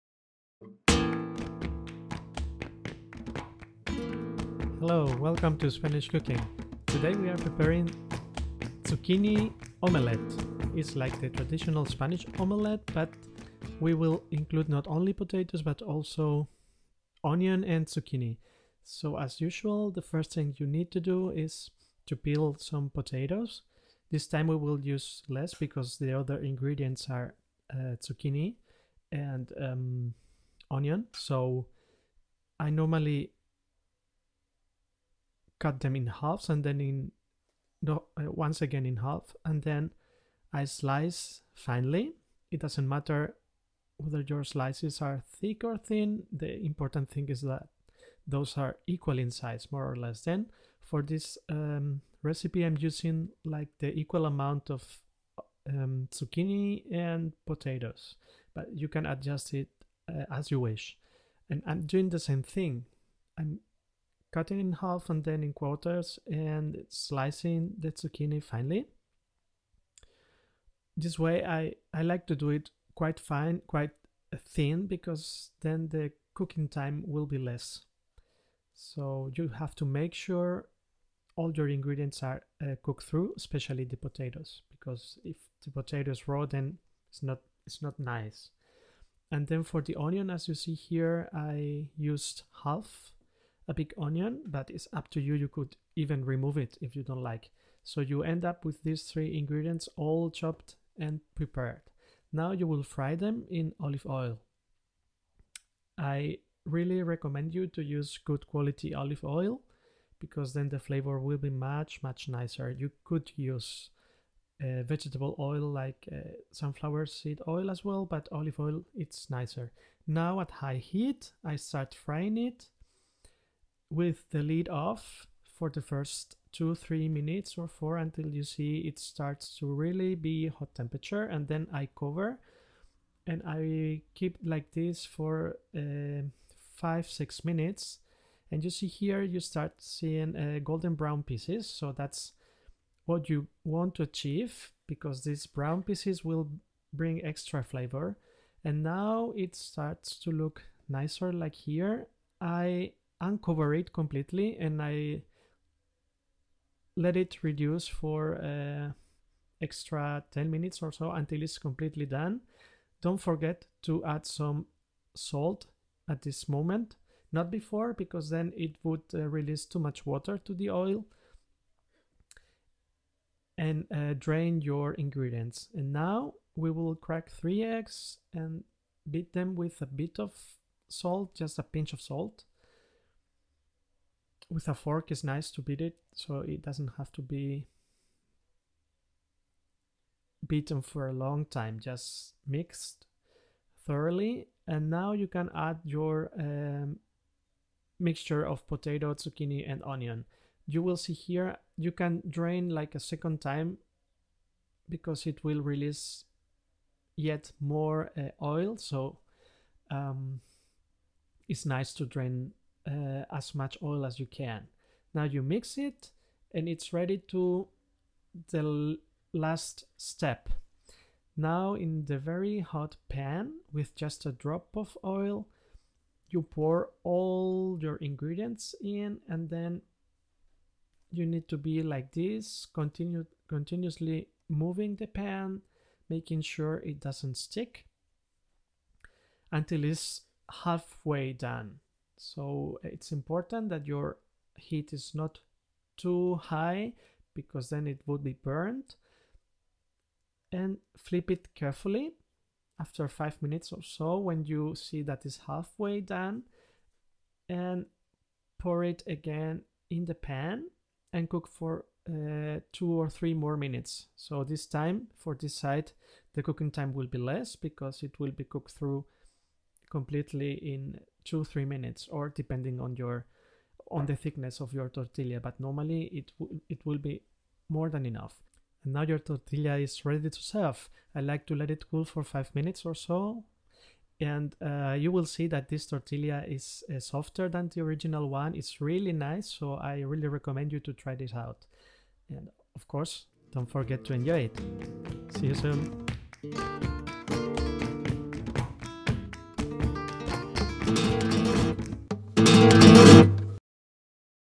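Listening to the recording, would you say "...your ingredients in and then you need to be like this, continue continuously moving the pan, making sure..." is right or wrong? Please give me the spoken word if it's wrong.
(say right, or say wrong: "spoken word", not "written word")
right.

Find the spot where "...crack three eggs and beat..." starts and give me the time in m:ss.
2:56.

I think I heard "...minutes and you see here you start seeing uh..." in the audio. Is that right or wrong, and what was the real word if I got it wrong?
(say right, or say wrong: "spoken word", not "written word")
right.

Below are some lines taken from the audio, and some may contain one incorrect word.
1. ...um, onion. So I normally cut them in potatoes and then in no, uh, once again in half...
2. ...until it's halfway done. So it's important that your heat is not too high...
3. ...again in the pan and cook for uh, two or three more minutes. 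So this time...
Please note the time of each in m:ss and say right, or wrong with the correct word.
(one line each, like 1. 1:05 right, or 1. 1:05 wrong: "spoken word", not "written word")
1. 0:29 wrong: "halves", not "potatoes"
2. 3:59 right
3. 4:19 right.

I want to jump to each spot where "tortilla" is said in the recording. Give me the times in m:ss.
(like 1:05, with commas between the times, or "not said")
4:34, 4:39, 4:45.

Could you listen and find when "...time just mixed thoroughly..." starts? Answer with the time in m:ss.
3:11.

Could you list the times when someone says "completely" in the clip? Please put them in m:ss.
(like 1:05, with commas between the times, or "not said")
2:33, 2:41, 4:29.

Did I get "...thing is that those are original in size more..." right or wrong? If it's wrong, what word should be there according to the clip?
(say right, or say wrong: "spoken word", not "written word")
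wrong: "equal", not "original".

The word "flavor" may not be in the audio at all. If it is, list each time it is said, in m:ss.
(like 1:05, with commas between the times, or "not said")
1:50, 2:27.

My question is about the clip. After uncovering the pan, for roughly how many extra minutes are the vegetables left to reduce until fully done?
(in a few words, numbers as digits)
10.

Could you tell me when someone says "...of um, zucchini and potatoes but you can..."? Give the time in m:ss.
0:54.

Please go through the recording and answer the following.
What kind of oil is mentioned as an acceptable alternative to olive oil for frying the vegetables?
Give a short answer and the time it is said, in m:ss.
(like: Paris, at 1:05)
sunflower seed oil, at 1:56.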